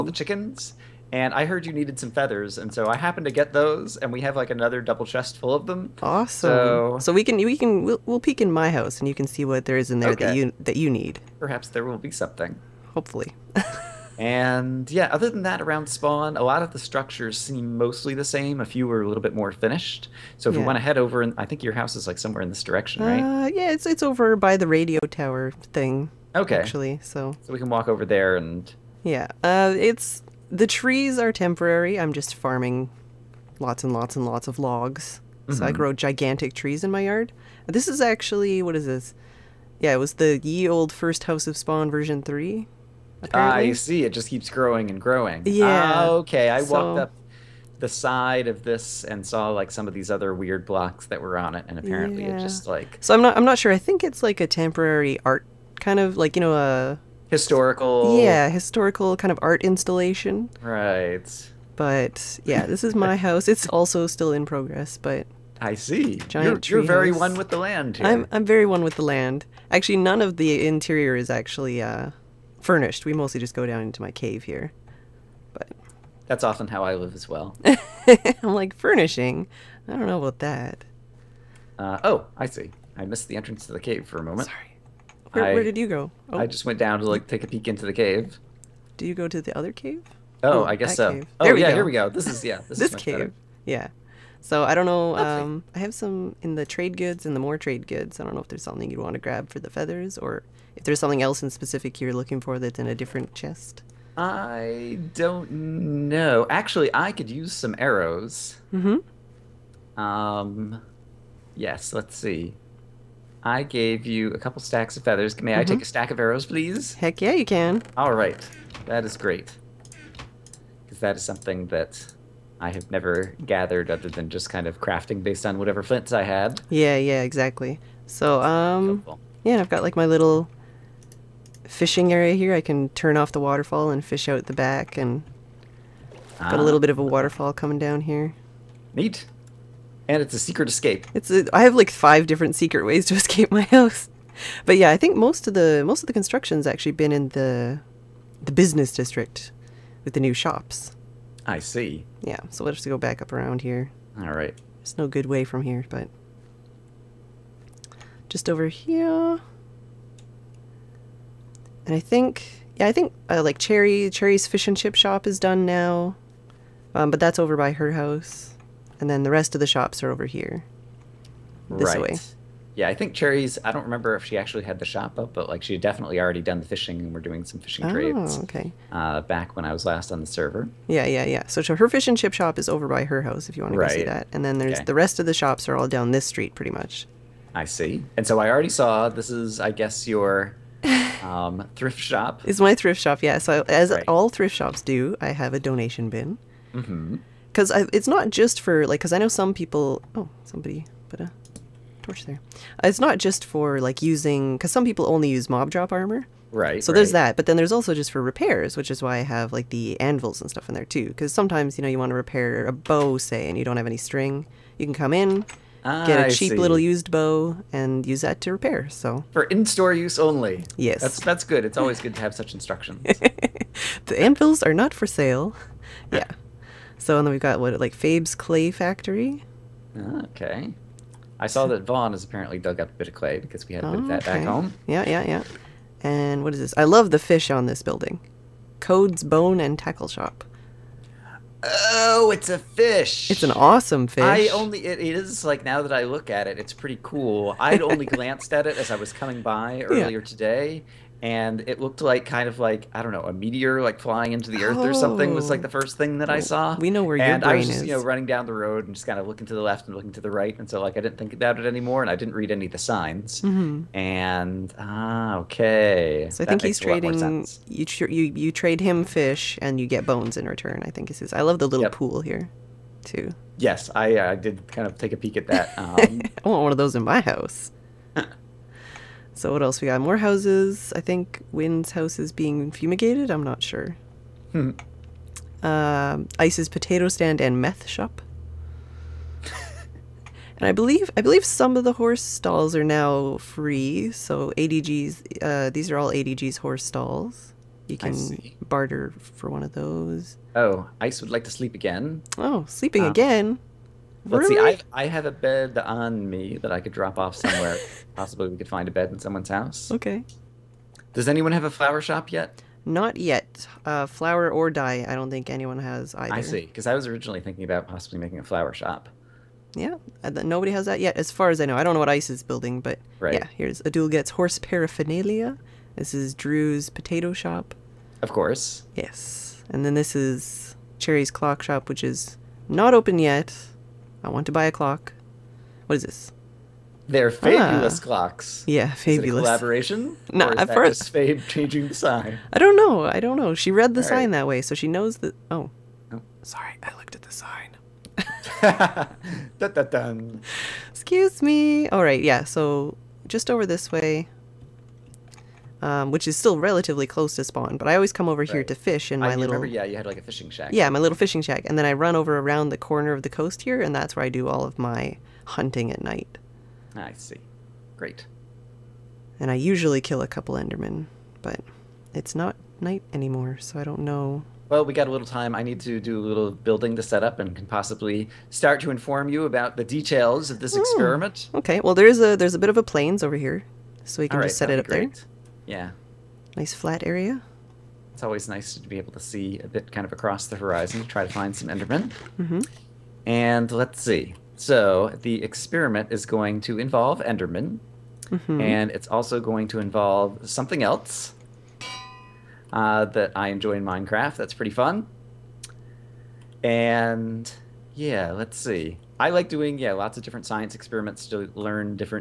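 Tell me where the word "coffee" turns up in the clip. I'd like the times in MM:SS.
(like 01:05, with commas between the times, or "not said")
not said.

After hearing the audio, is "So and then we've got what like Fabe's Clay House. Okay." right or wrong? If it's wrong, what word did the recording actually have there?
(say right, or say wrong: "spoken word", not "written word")
wrong: "Factory", not "House".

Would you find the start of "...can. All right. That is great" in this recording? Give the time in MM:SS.
01:57.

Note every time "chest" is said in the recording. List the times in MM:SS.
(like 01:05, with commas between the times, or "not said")
00:05, 01:43.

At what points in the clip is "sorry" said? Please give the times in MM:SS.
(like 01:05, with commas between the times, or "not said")
01:24, 05:46.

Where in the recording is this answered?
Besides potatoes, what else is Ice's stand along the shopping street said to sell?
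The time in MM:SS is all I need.
04:47.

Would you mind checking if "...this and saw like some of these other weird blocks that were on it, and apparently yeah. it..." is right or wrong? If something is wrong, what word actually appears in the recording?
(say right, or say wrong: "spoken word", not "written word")
right.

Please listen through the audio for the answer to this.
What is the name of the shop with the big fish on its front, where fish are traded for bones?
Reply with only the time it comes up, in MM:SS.
03:58.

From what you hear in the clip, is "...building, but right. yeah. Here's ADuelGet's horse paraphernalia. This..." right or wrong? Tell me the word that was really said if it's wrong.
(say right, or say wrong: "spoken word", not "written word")
right.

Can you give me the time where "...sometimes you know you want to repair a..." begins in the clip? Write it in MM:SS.
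03:31.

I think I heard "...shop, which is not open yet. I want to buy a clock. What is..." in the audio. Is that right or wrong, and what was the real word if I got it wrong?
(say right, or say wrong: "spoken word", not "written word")
right.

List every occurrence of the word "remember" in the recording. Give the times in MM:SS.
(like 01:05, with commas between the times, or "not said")
02:53, 05:59.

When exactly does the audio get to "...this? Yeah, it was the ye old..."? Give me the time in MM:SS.
00:38.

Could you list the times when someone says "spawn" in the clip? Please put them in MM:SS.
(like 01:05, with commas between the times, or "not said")
00:15, 00:41, 05:57.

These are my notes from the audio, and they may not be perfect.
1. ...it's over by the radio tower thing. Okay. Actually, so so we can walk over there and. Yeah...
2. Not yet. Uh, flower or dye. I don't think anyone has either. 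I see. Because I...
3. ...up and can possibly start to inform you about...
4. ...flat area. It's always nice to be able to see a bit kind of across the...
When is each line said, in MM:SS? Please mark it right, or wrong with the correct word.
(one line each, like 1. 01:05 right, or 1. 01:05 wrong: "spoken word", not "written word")
1. 00:23 right
2. 05:12 right
3. 06:17 right
4. 06:26 right.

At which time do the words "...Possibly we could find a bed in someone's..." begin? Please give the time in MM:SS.
05:08.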